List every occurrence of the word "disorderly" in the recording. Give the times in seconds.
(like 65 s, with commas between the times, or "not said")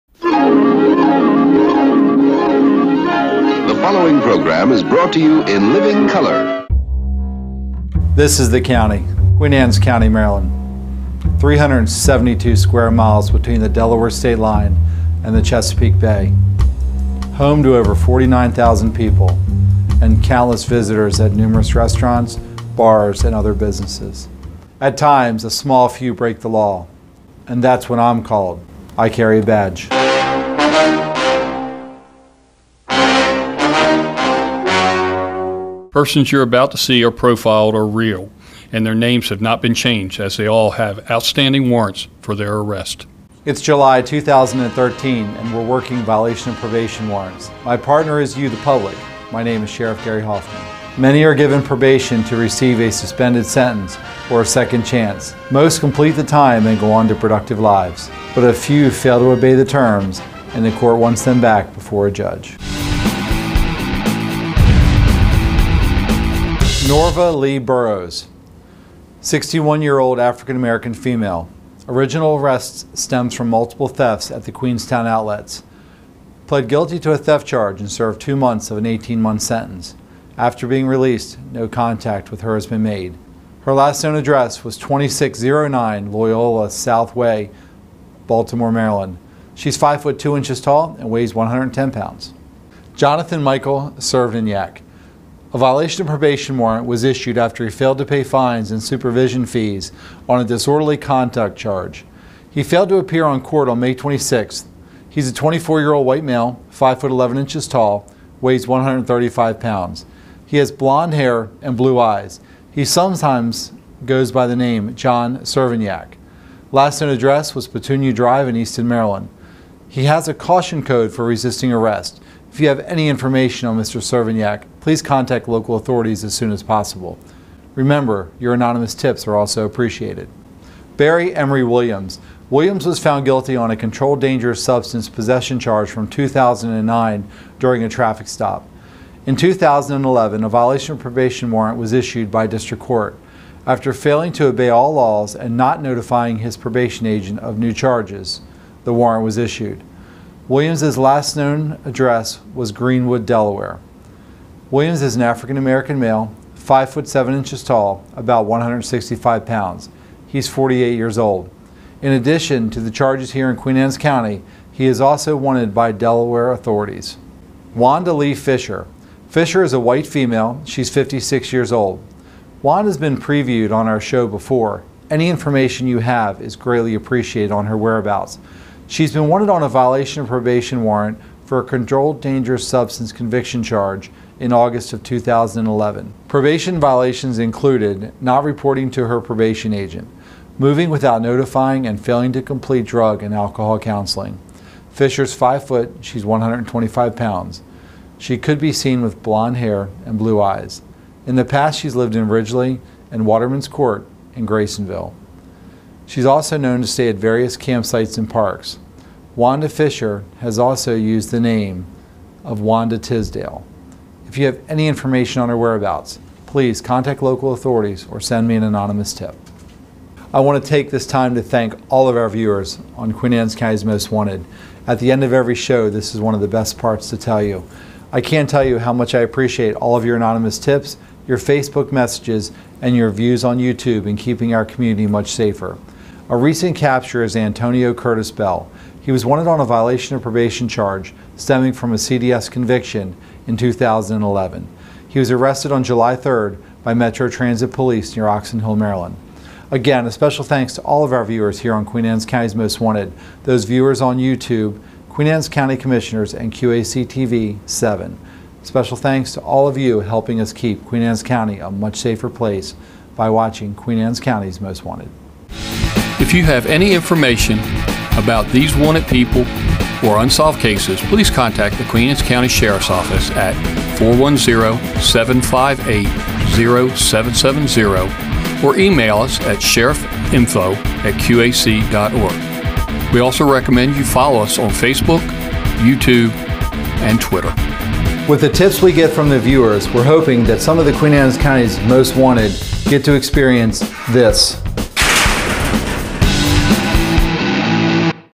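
100 s.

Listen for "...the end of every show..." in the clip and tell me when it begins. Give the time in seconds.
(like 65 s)
224 s.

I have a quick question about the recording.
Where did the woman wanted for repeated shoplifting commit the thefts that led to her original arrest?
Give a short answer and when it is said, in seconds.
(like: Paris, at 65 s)
Queenstown outlets, at 74 s.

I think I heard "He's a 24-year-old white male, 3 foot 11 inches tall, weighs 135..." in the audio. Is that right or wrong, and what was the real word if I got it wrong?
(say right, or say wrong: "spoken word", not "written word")
wrong: "5", not "3".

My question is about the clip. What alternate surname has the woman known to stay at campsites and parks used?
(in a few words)
Tisdale.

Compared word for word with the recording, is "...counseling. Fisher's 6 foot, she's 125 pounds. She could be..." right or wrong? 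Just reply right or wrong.
wrong.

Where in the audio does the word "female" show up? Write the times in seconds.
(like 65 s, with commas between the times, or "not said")
70 s, 170 s.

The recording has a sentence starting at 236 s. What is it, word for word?
A recent capture is Antonio Curtis Bell.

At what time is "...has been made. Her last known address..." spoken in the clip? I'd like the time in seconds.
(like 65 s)
82 s.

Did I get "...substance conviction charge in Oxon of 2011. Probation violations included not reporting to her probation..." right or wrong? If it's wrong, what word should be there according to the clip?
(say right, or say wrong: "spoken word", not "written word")
wrong: "August", not "Oxon".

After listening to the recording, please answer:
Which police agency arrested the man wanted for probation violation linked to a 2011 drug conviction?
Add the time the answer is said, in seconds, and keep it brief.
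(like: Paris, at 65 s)
Metro Transit Police, at 246 s.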